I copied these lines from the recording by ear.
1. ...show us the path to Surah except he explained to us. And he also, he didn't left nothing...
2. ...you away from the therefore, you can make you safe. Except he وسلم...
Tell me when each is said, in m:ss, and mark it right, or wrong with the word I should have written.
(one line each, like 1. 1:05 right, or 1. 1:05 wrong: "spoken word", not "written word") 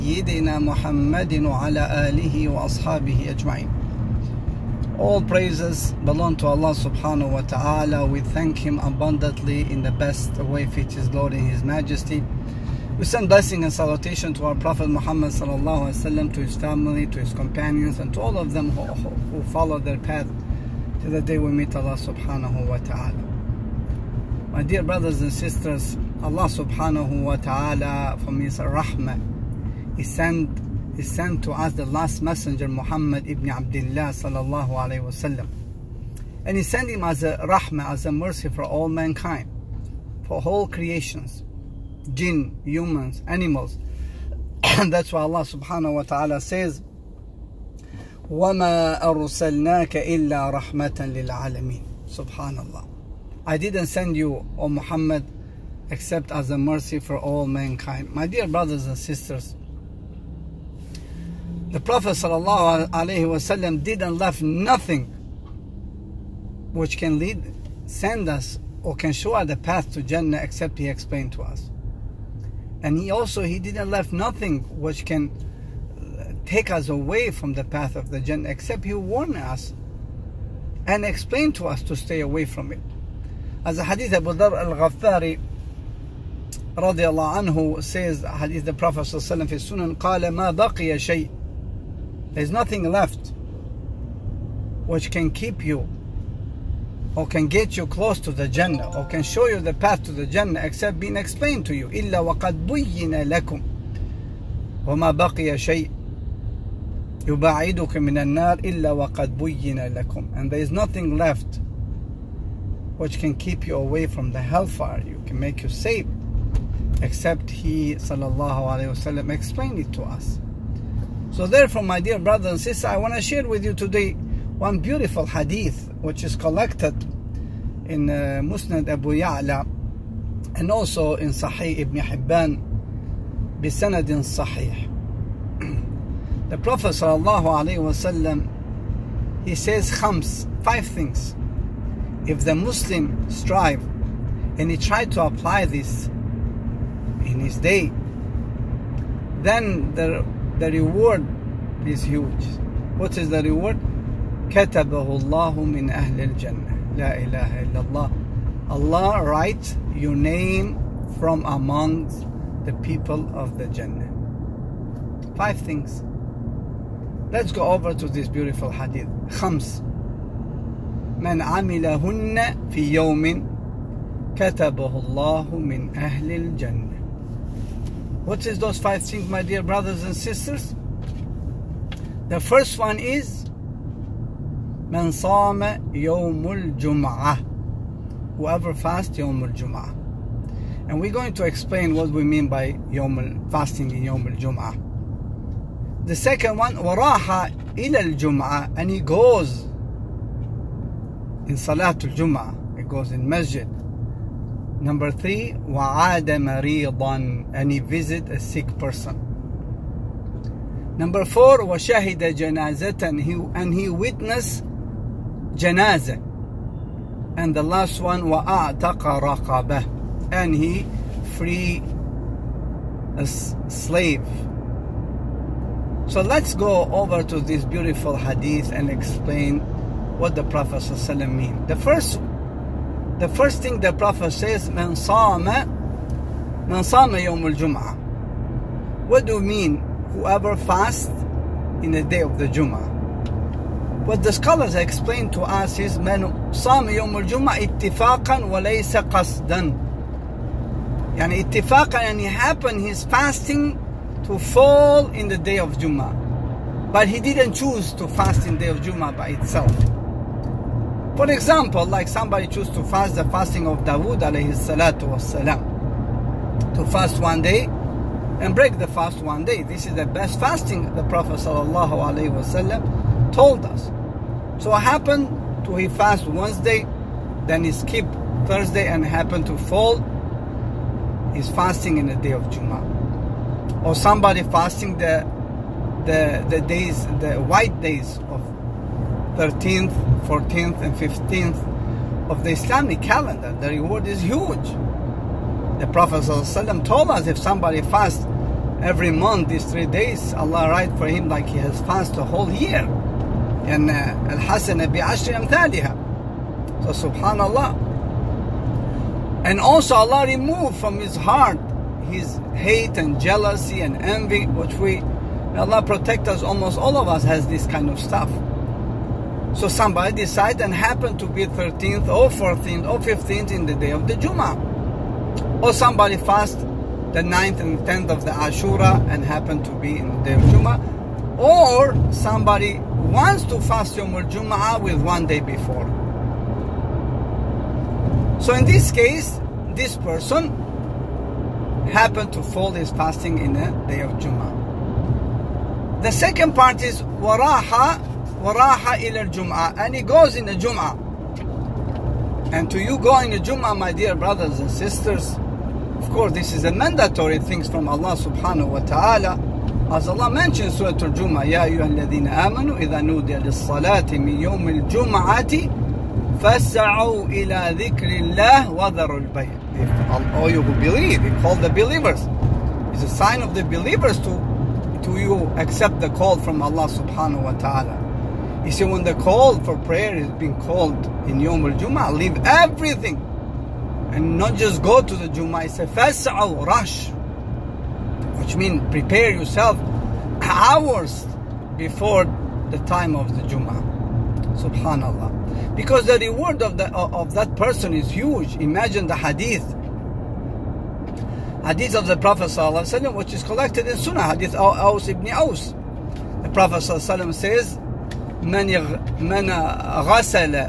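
1. 1:09 wrong: "Jannah", not "Surah"
2. 1:53 wrong: "hellfire", not "therefore".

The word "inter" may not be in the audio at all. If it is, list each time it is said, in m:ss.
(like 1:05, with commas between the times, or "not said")
not said.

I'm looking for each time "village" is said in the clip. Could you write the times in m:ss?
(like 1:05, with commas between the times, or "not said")
not said.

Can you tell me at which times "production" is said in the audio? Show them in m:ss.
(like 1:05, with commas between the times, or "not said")
not said.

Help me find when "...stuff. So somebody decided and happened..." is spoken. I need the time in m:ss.
5:17.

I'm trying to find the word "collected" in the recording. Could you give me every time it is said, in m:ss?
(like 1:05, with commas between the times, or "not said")
2:06, 6:43.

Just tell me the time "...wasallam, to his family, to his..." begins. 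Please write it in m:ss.
0:16.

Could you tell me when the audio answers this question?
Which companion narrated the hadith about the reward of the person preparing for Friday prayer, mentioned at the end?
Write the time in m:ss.
6:44.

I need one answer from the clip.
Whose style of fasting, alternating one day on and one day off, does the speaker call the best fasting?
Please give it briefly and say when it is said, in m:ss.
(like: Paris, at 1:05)
Dawood, at 4:23.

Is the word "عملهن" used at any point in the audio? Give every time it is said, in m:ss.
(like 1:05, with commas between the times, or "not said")
2:51.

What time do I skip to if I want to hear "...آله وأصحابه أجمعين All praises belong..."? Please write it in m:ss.
0:02.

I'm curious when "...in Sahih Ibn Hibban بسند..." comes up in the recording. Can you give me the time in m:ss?
2:11.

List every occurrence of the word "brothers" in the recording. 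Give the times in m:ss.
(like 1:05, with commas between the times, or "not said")
0:24, 0:58, 2:02, 2:59, 5:54.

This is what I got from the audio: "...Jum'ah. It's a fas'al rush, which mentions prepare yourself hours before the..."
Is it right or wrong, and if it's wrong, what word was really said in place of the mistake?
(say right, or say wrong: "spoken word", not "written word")
wrong: "means", not "mentions".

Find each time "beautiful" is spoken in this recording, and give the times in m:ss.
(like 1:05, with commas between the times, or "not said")
2:04, 2:48, 3:47.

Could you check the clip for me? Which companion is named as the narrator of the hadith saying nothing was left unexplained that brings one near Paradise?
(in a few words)
Abu Dhar al-Ghaffari.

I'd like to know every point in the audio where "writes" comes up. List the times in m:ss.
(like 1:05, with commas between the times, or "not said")
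2:39, 5:00.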